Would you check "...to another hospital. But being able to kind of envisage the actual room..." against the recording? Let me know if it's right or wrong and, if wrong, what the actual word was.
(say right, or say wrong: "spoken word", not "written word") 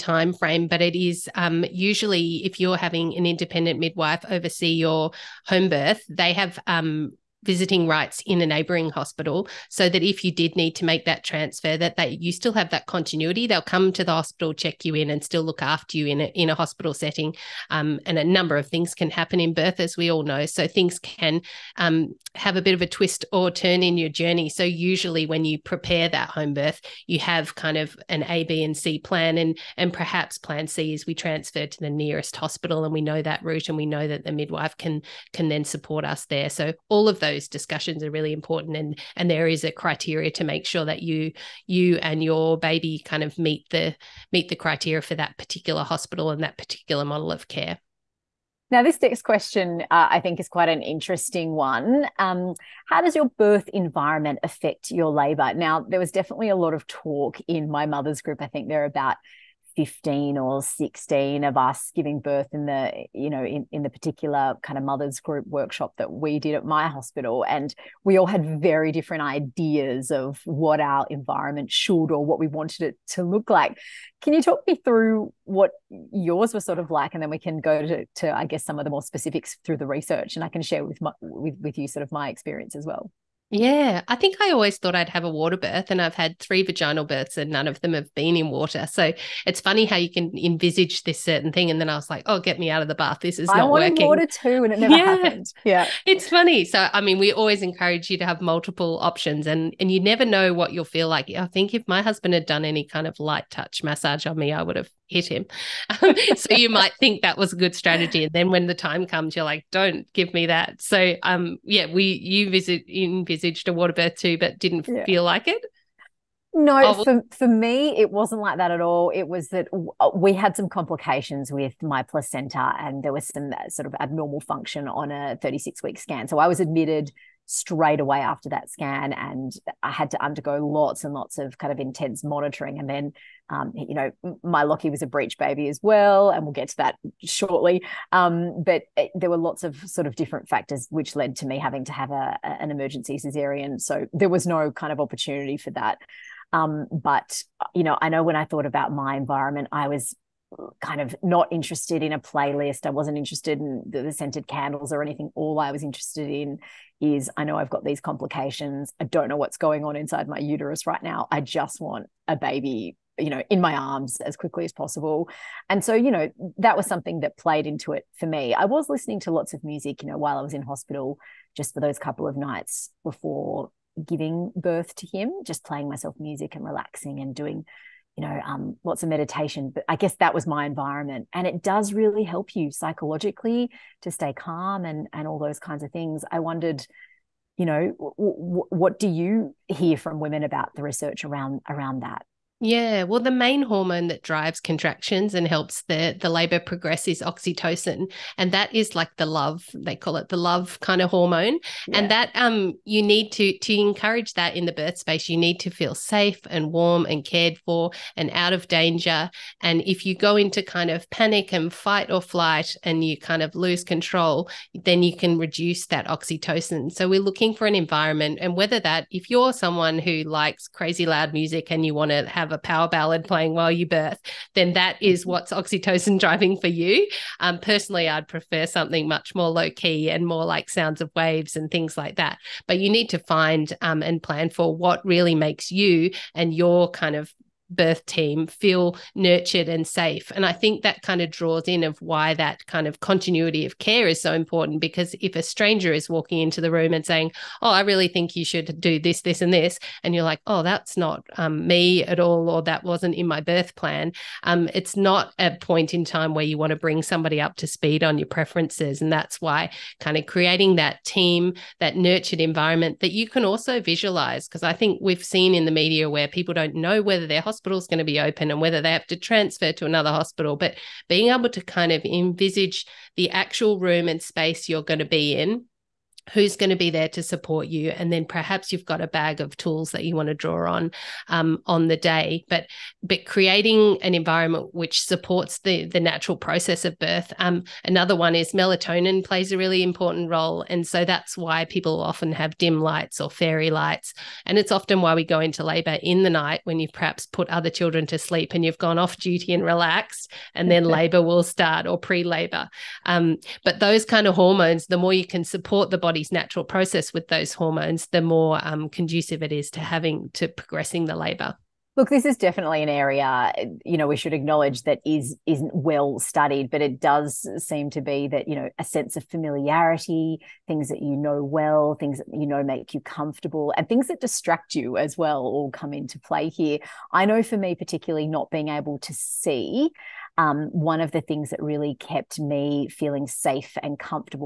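right.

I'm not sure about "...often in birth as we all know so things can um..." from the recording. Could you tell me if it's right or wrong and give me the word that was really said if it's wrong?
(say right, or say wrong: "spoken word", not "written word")
wrong: "happen", not "often".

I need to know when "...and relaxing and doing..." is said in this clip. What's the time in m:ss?
2:56.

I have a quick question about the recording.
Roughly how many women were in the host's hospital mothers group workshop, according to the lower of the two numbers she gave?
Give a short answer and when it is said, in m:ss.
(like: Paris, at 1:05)
15, at 0:59.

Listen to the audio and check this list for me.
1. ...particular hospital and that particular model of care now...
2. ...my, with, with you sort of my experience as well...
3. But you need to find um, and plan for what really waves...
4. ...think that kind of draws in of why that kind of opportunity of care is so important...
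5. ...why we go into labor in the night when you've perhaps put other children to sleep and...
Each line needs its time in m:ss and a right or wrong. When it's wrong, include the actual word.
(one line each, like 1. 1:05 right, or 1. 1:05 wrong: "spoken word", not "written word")
1. 0:45 right
2. 1:21 right
3. 3:52 wrong: "makes", not "waves"
4. 4:00 wrong: "continuity", not "opportunity"
5. 4:55 right.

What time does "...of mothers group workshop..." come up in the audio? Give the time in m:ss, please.
1:04.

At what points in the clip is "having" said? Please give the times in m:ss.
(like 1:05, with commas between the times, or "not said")
0:02, 2:21, 5:09.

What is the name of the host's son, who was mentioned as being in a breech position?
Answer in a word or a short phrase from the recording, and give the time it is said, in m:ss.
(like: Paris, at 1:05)
Lachie, at 2:14.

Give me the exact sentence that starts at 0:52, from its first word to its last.
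Um, how does your birth environment affect your labour?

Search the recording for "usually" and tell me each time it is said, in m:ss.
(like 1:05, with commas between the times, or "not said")
0:01, 0:24.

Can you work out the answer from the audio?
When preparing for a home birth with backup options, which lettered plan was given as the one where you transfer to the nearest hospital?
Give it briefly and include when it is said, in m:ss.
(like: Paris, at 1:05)
Plan C, at 0:30.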